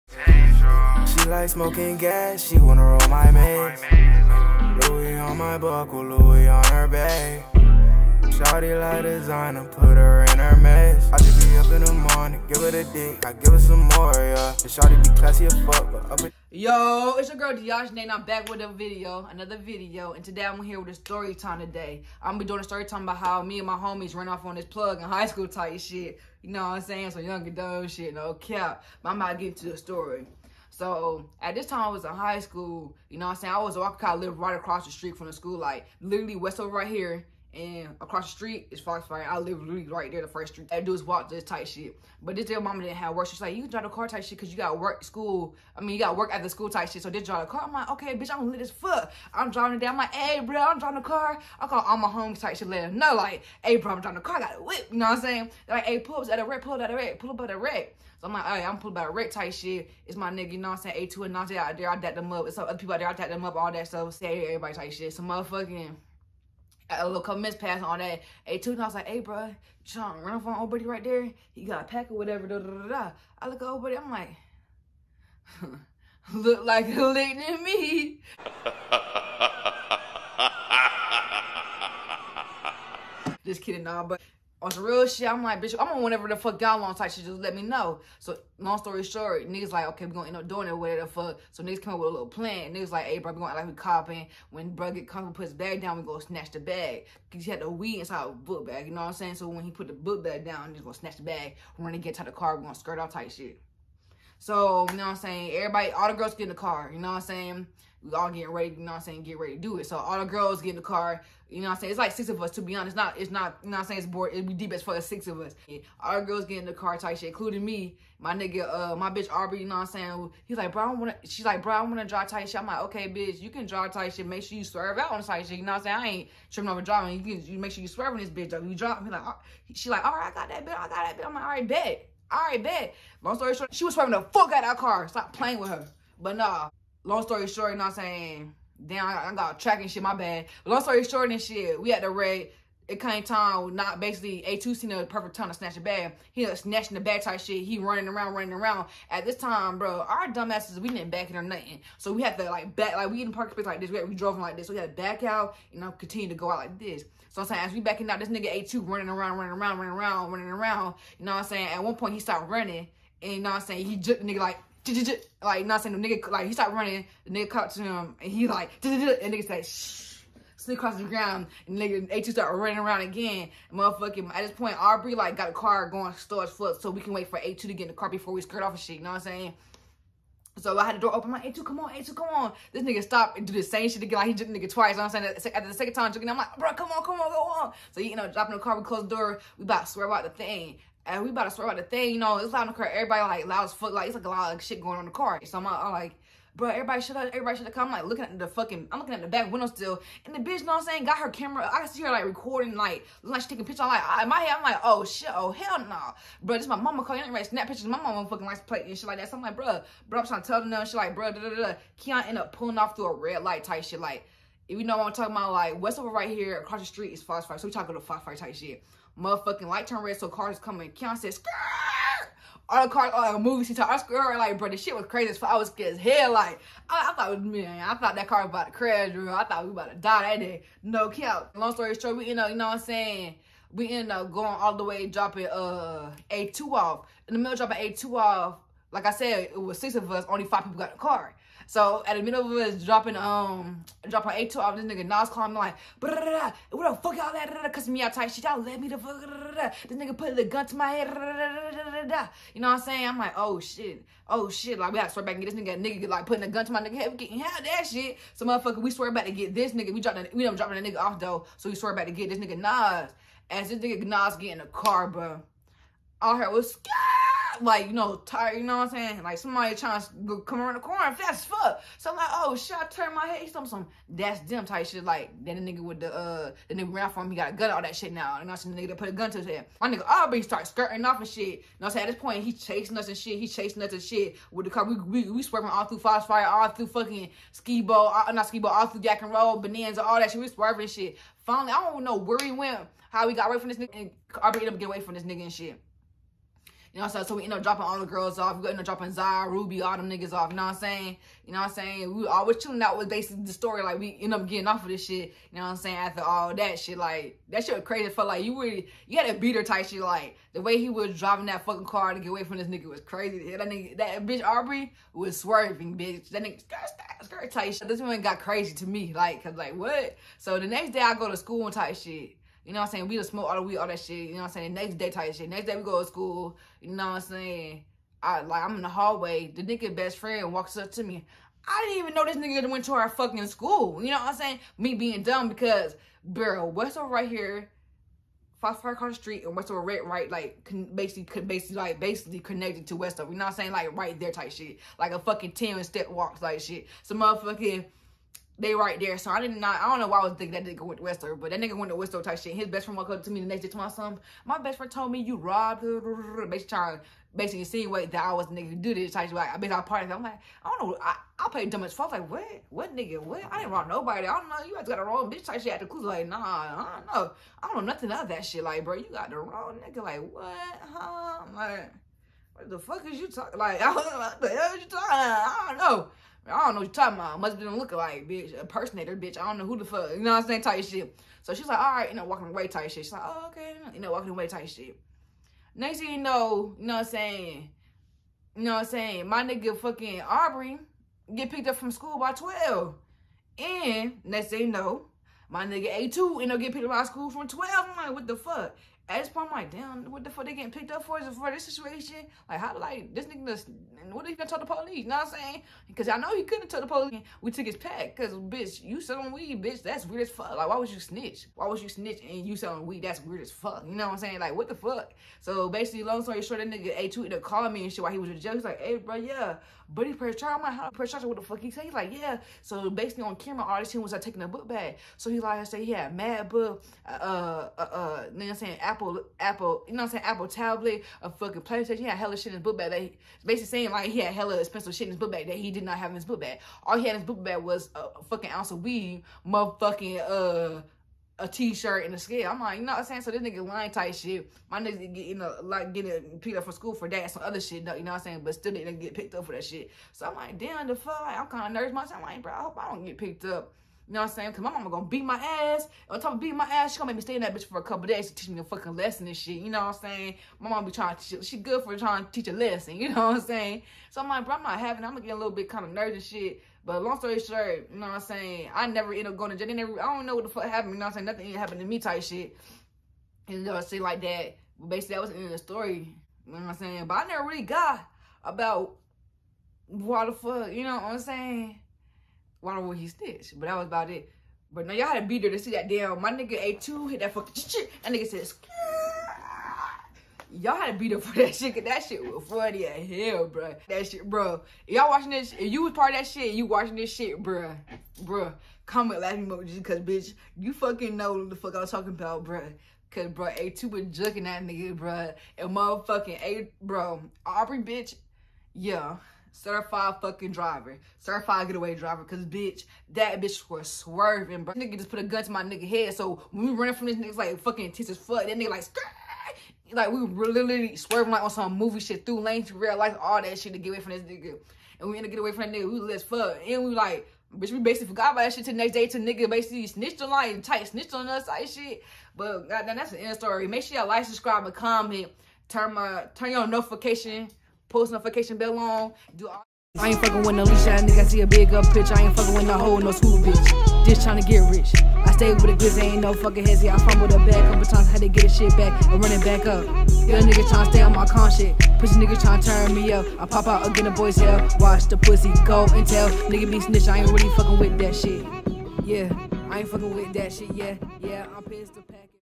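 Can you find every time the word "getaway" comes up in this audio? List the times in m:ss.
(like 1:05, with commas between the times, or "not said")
8:31.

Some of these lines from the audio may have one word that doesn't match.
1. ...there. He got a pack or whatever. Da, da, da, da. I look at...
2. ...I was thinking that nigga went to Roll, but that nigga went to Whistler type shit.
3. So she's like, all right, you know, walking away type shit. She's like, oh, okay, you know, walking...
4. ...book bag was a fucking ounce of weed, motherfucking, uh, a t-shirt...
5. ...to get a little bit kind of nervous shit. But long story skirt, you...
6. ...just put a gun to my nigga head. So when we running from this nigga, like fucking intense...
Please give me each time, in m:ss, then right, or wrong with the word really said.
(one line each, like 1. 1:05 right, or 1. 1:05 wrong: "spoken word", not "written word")
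1. 1:11 right
2. 5:50 wrong: "Whistler", not "Roll"
3. 6:21 right
4. 7:17 right
5. 7:45 wrong: "short", not "skirt"
6. 8:34 right.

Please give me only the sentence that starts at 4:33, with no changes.
some some that's them type shit.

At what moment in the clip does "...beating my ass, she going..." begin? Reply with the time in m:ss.
7:36.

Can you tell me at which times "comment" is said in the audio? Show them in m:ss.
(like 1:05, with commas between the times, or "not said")
8:18, 8:54.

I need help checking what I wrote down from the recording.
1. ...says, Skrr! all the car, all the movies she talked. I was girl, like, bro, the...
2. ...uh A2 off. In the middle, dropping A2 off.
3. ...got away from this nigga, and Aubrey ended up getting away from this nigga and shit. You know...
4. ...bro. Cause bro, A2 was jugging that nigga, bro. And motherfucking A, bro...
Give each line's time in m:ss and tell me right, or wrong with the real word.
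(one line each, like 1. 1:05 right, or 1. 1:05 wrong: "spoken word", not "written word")
1. 3:41 right
2. 3:55 right
3. 4:53 right
4. 8:22 right.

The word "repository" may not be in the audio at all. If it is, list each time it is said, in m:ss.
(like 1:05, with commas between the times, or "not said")
not said.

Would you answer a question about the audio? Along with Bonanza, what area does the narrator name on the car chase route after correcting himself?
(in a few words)
Jack and Roll.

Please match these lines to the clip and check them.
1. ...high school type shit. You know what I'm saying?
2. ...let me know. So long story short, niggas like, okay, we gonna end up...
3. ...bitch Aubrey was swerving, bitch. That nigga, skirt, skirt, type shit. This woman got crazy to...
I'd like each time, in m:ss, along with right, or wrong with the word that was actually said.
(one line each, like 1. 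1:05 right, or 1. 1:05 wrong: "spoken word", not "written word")
1. 0:25 right
2. 1:27 right
3. 5:14 right.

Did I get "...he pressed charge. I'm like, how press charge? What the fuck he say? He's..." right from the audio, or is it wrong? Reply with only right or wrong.
right.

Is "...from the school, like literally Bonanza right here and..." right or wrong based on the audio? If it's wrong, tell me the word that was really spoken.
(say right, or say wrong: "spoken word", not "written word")
wrong: "Westover", not "Bonanza".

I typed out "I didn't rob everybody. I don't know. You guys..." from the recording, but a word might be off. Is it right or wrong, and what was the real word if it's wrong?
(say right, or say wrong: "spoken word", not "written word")
wrong: "nobody", not "everybody".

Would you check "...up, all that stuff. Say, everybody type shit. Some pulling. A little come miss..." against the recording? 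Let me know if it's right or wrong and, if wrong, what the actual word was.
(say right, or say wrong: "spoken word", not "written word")
wrong: "motherfucking", not "pulling".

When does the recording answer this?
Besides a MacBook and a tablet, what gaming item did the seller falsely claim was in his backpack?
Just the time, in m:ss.
7:11.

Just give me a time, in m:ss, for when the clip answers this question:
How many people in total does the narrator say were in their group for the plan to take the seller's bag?
1:51.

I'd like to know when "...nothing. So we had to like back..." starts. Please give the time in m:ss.
2:31.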